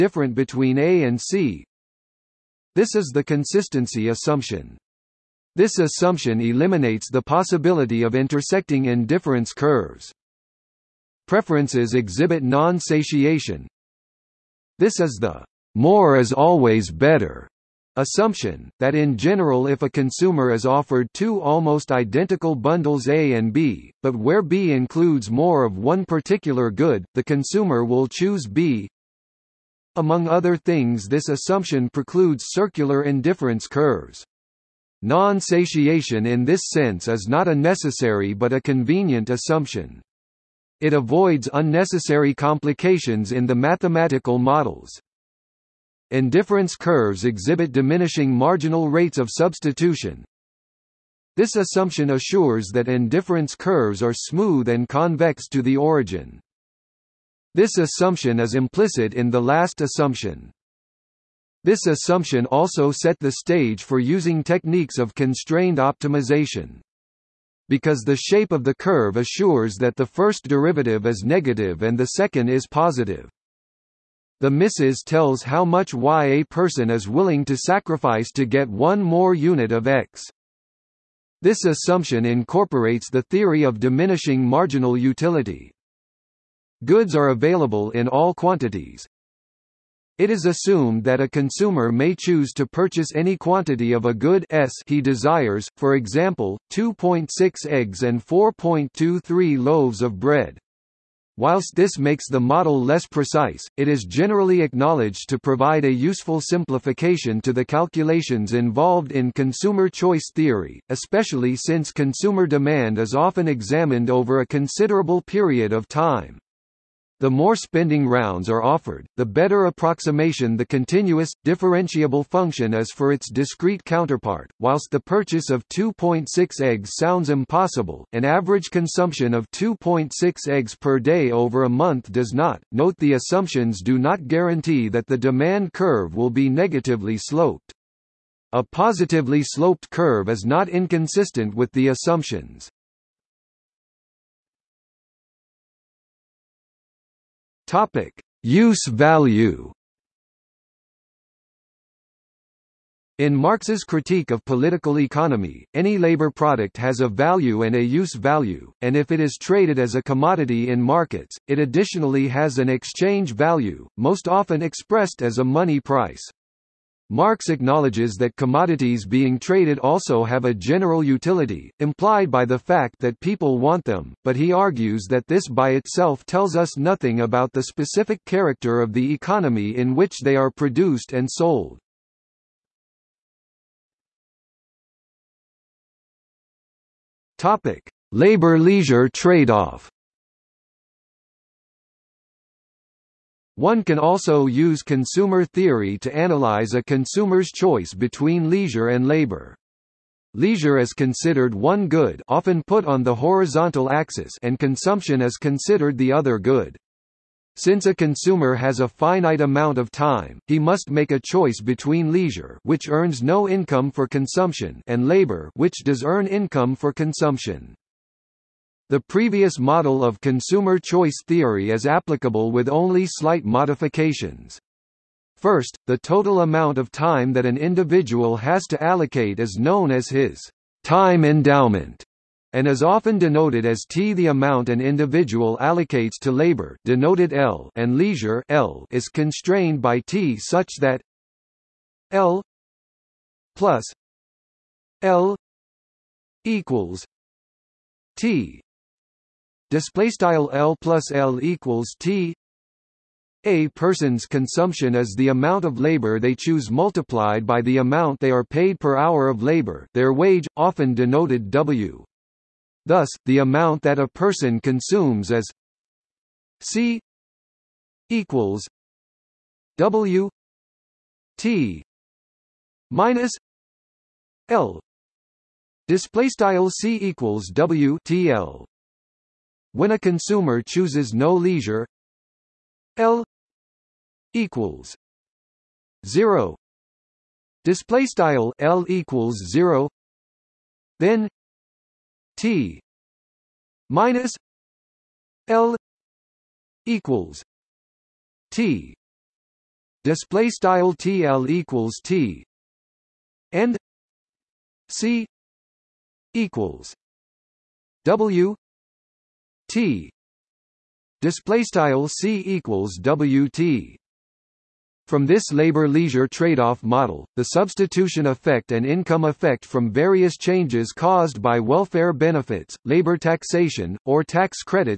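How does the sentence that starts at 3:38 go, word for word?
The previous model of consumer choice theory is applicable with only slight modifications.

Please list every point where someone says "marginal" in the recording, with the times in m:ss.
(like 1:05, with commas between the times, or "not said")
0:48, 1:24.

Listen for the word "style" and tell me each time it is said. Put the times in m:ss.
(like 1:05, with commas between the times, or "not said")
4:10, 4:36, 4:48, 5:00, 5:11.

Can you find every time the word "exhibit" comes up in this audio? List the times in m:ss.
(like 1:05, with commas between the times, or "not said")
0:11, 0:47.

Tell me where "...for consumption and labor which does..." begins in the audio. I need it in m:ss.
3:33.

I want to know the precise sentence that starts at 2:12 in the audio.
Note the assumptions do not guarantee that the demand curve will be negatively sloped.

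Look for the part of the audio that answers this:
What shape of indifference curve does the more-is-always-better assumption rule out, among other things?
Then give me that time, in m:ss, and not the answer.
0:32.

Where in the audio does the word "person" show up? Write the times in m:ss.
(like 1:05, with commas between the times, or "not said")
1:16, 4:13, 4:24.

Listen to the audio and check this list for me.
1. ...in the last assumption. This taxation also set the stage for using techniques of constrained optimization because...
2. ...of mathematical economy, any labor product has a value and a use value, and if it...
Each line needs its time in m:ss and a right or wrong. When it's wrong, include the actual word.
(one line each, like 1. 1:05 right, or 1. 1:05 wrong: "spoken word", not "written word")
1. 0:59 wrong: "assumption", not "taxation"
2. 2:34 wrong: "political", not "mathematical".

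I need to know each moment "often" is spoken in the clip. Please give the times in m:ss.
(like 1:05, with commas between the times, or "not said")
1:53, 2:44, 3:22, 3:52, 4:20.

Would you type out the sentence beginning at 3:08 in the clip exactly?
Labor-leisure trade-off One can also use consumer theory to analyze a consumer's choice between leisure and labor.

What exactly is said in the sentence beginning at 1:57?
The more spending rounds are offered, the better approximation the continuous, differentiable function is for its discrete counterpart.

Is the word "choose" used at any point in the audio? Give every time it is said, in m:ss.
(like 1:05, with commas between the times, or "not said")
0:28, 1:32, 4:16, 4:40.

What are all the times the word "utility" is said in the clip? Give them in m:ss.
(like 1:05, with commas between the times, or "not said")
1:24, 2:51.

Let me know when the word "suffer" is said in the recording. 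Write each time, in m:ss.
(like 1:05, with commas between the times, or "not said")
not said.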